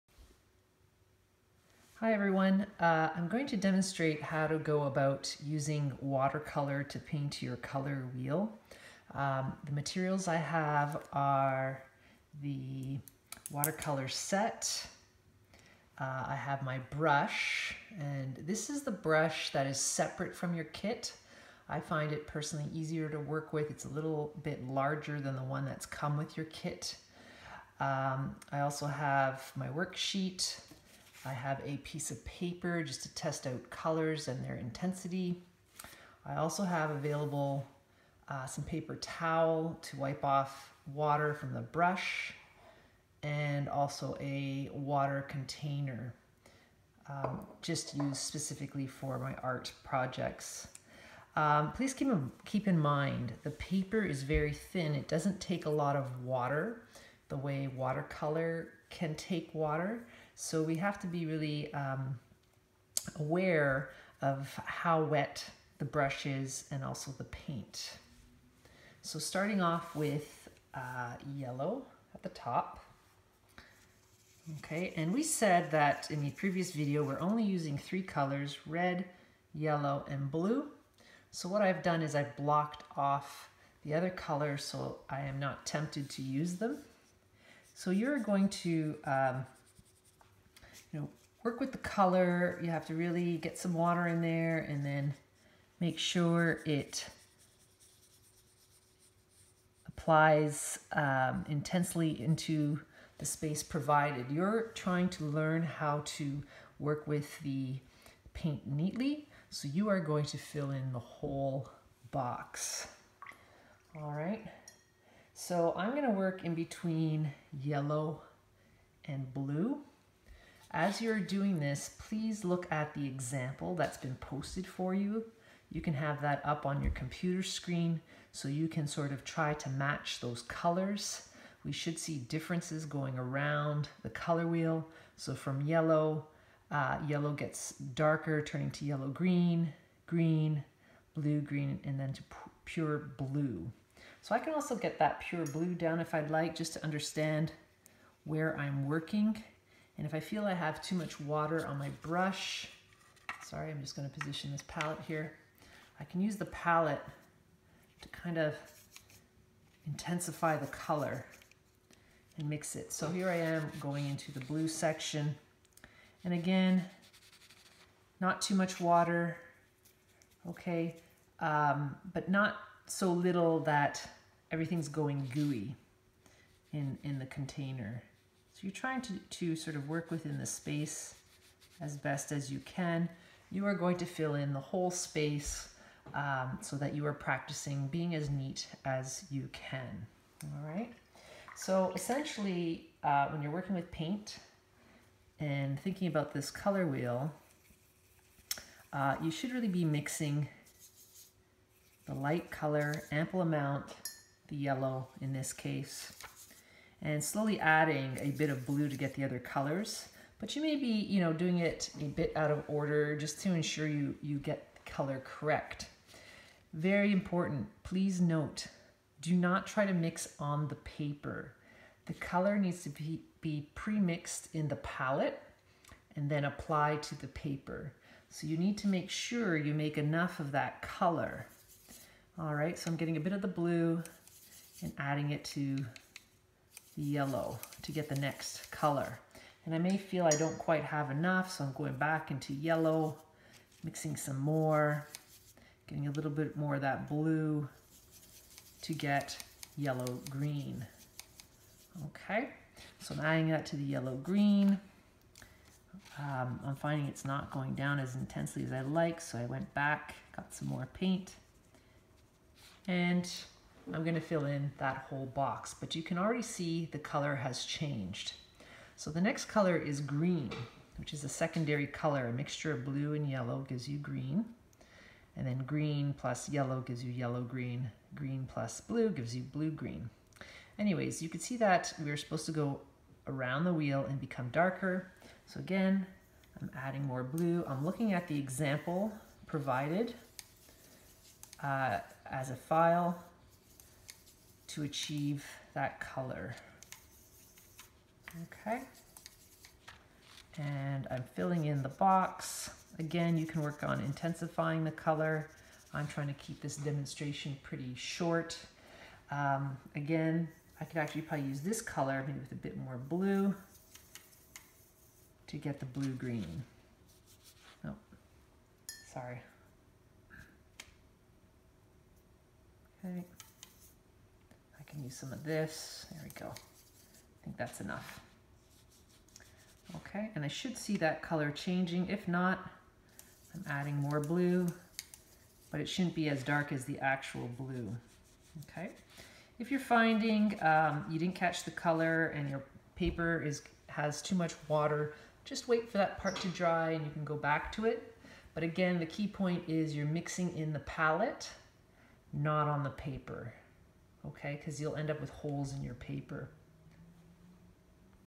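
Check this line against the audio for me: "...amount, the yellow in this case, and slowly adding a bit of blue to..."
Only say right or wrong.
right.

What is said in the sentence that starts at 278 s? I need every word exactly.
Green plus blue gives you blue-green.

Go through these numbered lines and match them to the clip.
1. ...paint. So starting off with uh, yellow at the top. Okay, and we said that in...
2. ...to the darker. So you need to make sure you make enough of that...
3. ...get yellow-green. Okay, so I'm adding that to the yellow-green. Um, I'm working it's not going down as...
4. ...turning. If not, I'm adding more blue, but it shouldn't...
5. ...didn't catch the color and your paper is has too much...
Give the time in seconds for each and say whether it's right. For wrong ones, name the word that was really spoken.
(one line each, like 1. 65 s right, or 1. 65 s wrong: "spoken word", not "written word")
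1. 67 s right
2. 226 s wrong: "paper", not "darker"
3. 248 s wrong: "finding", not "working"
4. 331 s wrong: "changing", not "turning"
5. 341 s right.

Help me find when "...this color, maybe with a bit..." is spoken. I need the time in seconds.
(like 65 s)
311 s.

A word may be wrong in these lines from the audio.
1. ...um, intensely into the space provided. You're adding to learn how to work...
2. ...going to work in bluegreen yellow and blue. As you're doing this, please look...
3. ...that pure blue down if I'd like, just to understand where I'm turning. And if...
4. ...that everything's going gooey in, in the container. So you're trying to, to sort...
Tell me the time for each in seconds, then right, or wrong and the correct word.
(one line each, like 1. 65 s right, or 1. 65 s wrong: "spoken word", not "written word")
1. 100 s wrong: "trying", not "adding"
2. 115 s wrong: "between", not "bluegreen"
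3. 144 s wrong: "working", not "turning"
4. 173 s right.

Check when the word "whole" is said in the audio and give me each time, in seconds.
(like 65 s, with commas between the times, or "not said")
110 s, 184 s, 265 s.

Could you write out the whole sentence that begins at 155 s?
I can use the palette to kind of intensify the color and mix it.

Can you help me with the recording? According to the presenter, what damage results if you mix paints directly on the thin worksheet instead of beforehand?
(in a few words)
holes in your paper.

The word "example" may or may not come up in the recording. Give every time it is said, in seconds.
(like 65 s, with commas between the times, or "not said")
123 s, 288 s.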